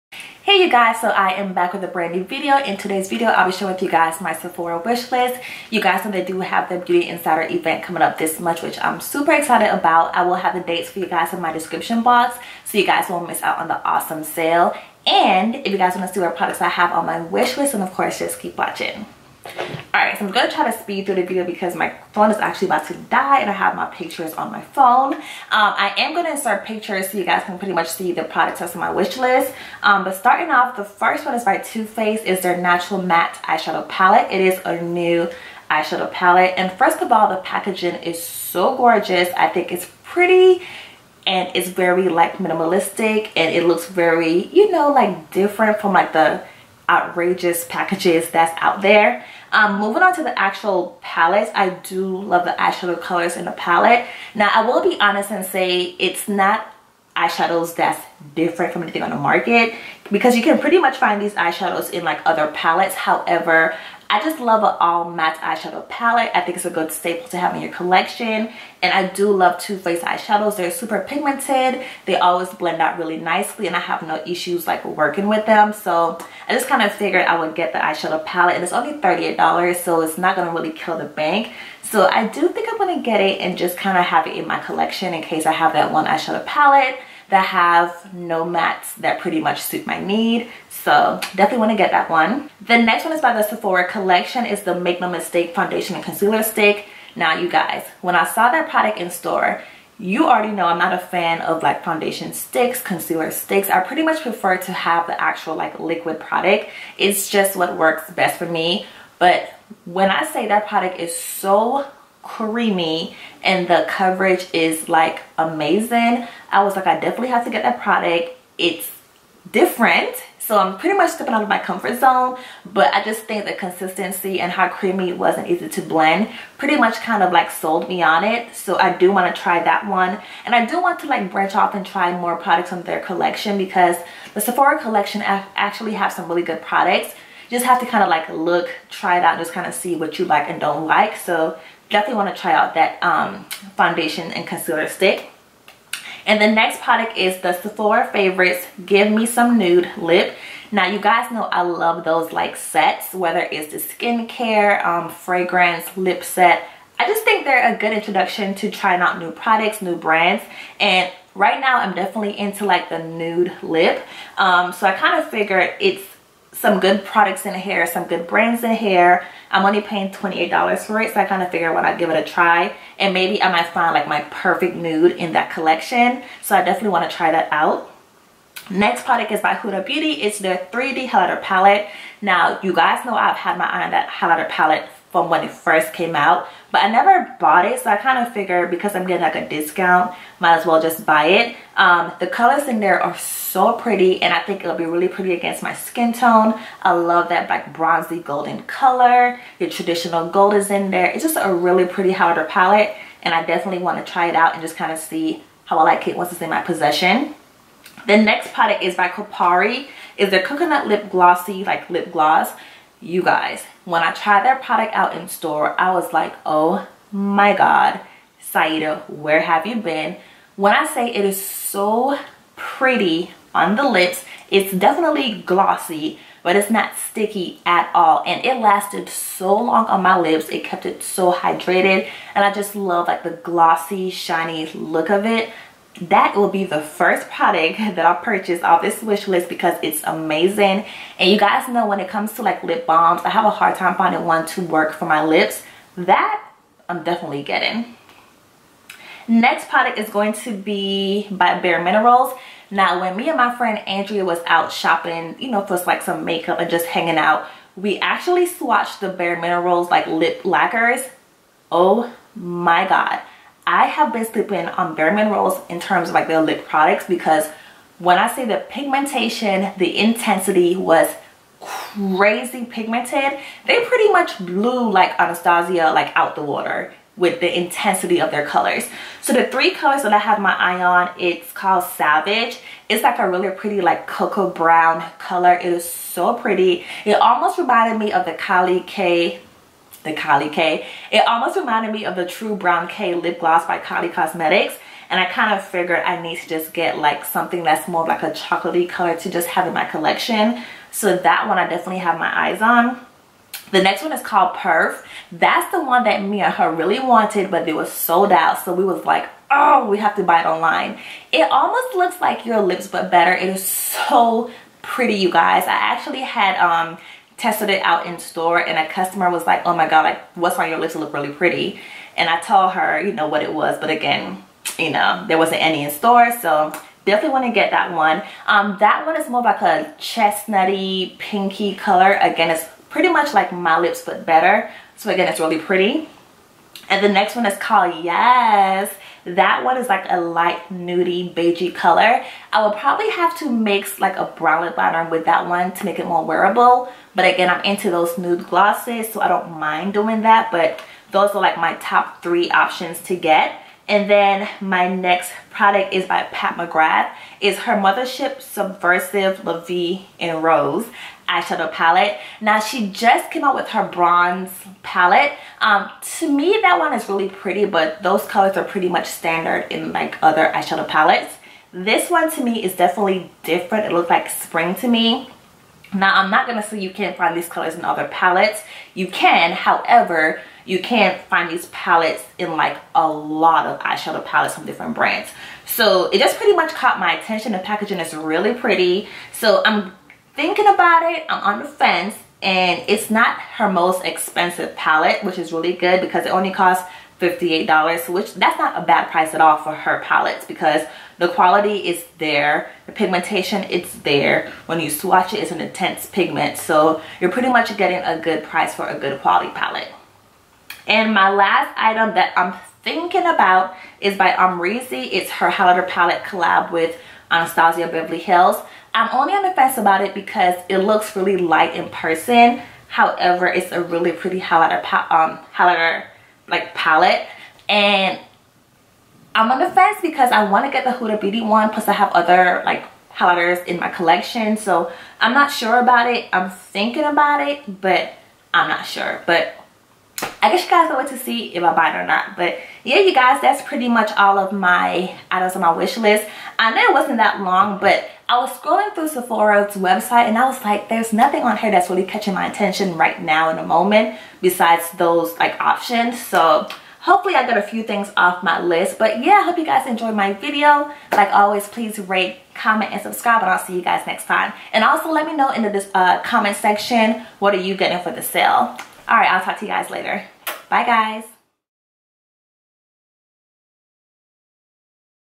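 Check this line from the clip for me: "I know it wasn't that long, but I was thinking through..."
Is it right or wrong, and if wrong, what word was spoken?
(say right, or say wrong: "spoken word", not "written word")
wrong: "scrolling", not "thinking".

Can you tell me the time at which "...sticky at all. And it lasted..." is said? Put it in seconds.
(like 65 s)
226 s.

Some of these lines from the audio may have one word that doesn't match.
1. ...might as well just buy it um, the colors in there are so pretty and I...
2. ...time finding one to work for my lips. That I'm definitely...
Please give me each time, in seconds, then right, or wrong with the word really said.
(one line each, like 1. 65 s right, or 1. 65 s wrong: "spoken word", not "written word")
1. 190 s right
2. 243 s right.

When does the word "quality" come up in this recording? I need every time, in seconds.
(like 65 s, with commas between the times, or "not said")
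401 s, 409 s.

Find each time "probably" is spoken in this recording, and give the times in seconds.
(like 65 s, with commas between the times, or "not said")
342 s.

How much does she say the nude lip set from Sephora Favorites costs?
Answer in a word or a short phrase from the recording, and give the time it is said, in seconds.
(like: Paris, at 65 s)
$28, at 170 s.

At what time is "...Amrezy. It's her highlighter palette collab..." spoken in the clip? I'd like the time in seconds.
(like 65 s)
414 s.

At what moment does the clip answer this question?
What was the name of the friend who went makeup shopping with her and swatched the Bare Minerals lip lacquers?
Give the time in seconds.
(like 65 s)
253 s.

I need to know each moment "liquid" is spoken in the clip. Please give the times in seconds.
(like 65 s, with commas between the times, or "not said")
105 s.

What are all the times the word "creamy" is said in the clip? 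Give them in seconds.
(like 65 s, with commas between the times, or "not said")
112 s, 124 s.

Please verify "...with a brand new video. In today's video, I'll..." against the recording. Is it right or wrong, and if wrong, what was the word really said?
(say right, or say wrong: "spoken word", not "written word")
right.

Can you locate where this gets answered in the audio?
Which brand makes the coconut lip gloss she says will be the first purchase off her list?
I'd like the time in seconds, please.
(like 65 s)
209 s.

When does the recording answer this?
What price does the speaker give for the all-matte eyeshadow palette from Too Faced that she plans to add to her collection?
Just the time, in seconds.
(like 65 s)
78 s.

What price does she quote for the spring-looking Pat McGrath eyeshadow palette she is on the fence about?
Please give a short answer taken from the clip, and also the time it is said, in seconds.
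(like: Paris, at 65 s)
$58, at 397 s.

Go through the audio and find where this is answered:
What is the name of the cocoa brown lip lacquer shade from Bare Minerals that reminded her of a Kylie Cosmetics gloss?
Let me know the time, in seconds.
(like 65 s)
281 s.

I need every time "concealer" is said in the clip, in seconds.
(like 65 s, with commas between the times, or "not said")
96 s, 102 s, 144 s.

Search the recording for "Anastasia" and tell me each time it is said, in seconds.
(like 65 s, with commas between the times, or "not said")
275 s, 417 s.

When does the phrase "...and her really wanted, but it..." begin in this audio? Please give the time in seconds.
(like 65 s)
306 s.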